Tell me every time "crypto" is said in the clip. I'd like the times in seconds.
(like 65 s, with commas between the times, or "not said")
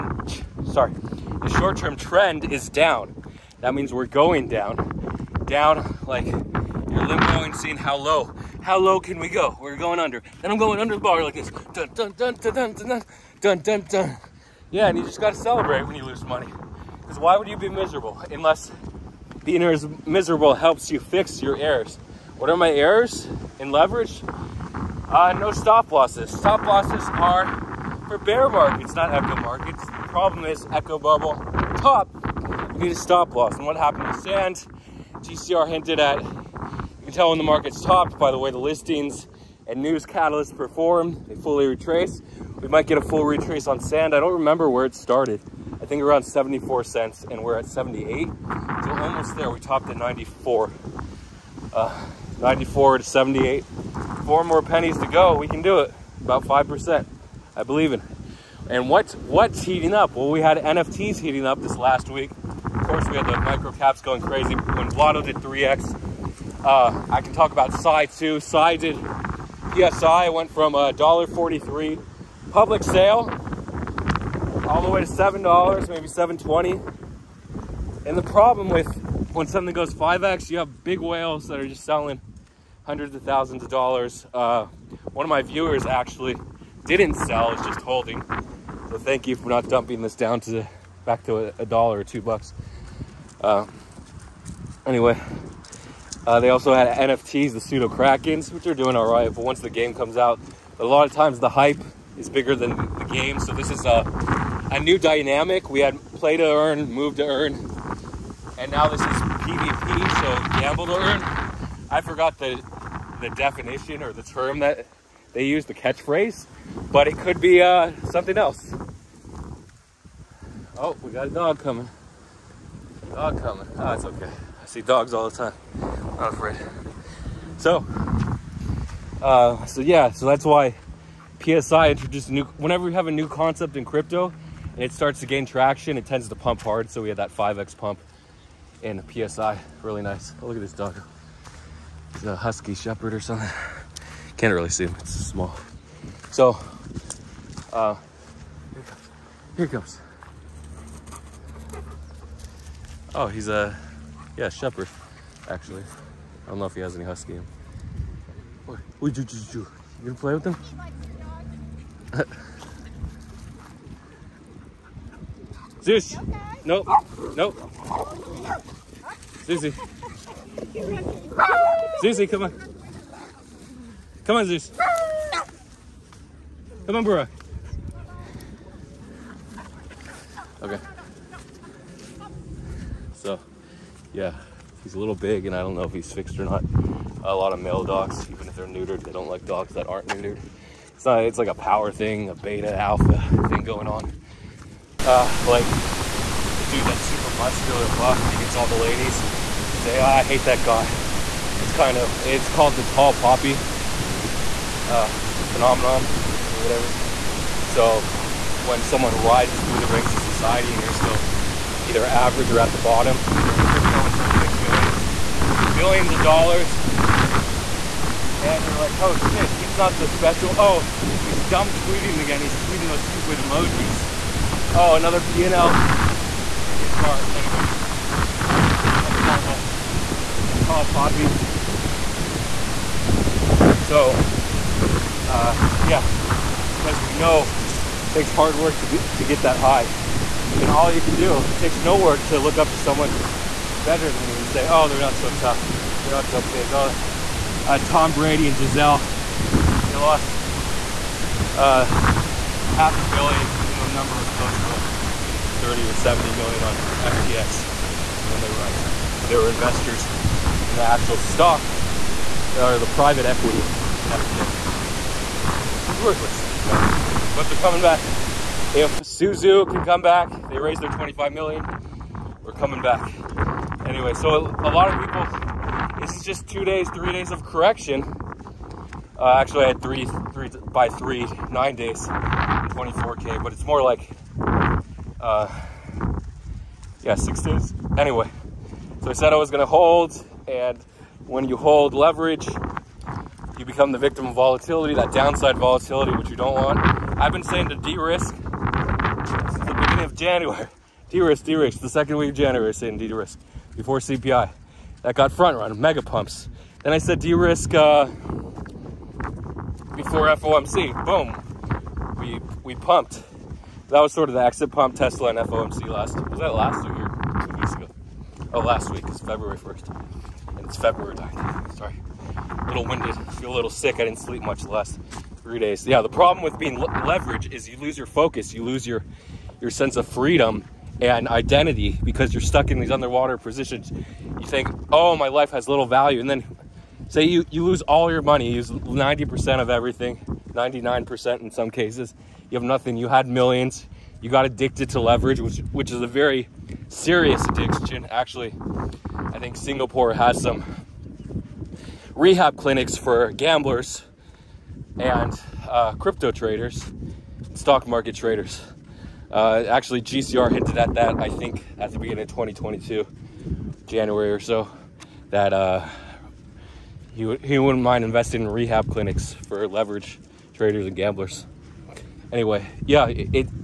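133 s, 213 s, 355 s.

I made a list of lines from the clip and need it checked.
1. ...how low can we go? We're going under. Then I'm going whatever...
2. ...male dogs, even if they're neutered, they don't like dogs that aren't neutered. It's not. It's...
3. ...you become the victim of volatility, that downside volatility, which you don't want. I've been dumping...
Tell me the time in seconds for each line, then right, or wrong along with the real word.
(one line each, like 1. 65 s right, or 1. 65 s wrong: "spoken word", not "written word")
1. 8 s wrong: "under", not "whatever"
2. 187 s right
3. 293 s wrong: "saying", not "dumping".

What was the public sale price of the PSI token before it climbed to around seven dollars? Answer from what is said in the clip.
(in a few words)
$1.43.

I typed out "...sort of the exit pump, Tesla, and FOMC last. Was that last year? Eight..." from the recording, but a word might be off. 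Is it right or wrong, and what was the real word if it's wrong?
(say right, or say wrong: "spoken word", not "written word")
wrong: "Two", not "Eight".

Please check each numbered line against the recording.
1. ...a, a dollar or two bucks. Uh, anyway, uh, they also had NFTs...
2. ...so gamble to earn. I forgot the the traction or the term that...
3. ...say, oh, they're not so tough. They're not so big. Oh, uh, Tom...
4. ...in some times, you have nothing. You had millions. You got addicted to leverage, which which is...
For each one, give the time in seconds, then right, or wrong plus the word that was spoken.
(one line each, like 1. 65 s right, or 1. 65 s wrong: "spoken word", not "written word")
1. 91 s right
2. 110 s wrong: "definition", not "traction"
3. 244 s right
4. 341 s wrong: "cases", not "times".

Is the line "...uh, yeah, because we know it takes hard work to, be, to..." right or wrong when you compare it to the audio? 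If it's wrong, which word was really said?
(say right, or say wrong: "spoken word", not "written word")
right.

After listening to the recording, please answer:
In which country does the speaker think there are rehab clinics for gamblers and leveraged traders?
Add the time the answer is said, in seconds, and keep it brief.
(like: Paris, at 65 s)
Singapore, at 349 s.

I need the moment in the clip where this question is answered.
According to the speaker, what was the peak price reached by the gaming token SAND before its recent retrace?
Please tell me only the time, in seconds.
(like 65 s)
49 s.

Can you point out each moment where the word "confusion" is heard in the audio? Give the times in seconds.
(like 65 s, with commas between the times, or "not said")
not said.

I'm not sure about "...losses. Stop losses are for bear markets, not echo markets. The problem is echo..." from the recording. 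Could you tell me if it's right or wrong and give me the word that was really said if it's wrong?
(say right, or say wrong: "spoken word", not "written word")
right.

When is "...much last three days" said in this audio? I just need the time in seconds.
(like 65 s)
324 s.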